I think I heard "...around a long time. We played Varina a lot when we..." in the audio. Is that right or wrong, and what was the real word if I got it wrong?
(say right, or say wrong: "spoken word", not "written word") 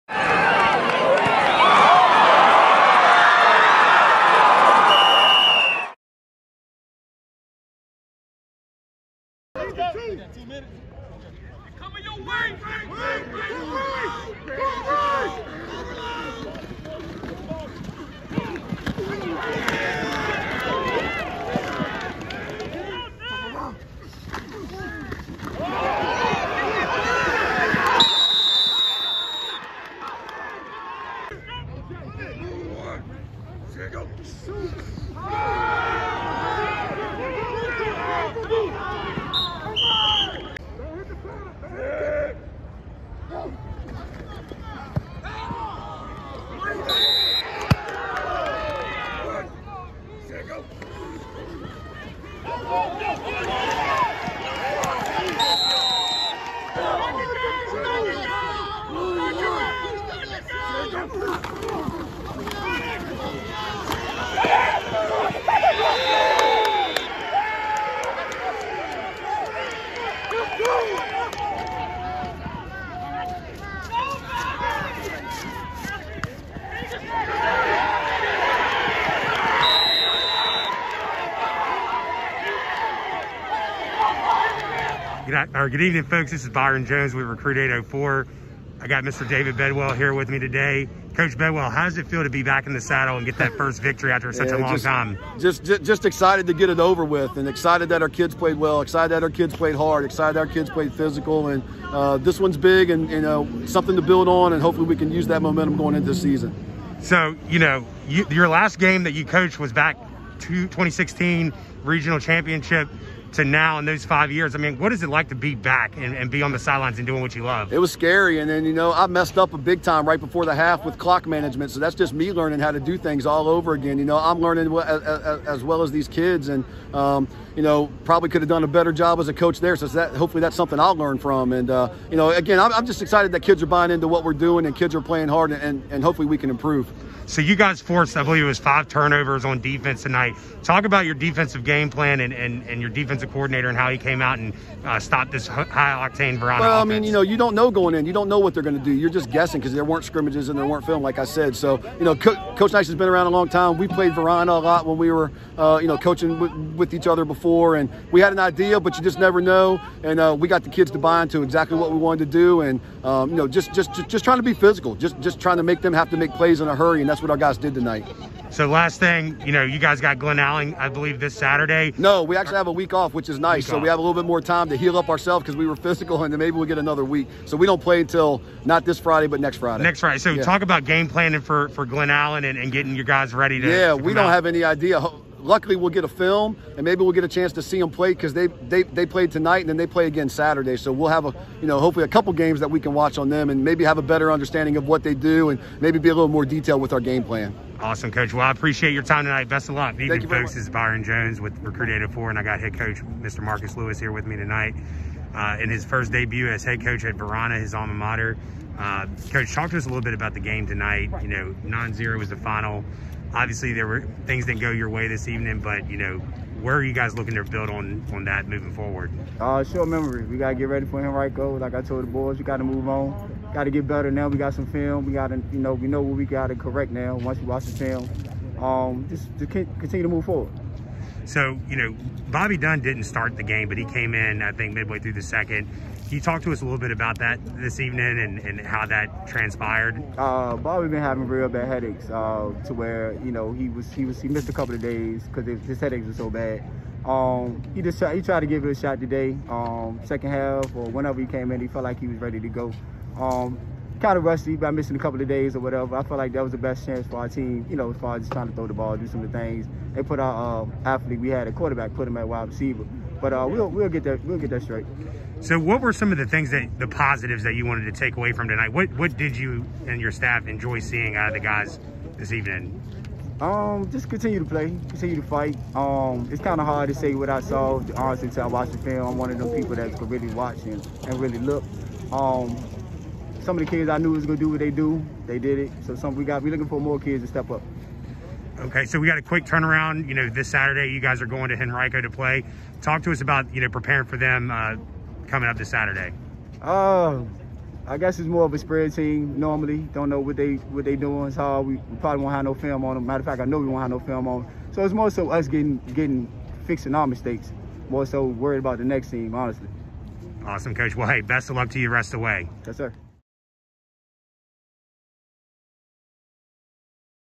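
right.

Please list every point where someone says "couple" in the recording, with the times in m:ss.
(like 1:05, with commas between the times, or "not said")
3:12, 4:04, 4:14.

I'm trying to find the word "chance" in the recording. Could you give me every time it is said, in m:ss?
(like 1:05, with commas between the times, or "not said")
3:07, 4:16.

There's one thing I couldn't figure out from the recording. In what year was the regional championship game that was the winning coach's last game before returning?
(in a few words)
2016.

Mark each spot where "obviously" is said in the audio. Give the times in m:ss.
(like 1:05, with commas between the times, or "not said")
3:33.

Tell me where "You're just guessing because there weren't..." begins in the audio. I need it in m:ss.
2:28.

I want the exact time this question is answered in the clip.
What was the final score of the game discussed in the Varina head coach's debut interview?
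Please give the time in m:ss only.
3:31.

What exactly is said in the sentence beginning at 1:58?
And then, you know, I messed up a big time right before the half with clock management.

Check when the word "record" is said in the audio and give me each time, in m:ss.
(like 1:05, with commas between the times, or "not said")
not said.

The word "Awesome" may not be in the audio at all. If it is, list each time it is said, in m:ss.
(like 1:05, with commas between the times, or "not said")
3:17, 5:10.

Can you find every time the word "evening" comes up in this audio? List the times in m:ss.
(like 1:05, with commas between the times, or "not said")
1:25, 3:20, 3:35, 3:57, 4:32.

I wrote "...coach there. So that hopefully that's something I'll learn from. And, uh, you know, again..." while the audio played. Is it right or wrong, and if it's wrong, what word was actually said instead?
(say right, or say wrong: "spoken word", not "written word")
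right.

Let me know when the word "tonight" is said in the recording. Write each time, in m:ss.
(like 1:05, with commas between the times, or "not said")
2:20, 2:47, 3:09, 3:19, 3:24, 3:30, 4:28.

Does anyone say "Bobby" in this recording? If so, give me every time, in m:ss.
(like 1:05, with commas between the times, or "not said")
3:52, 4:00.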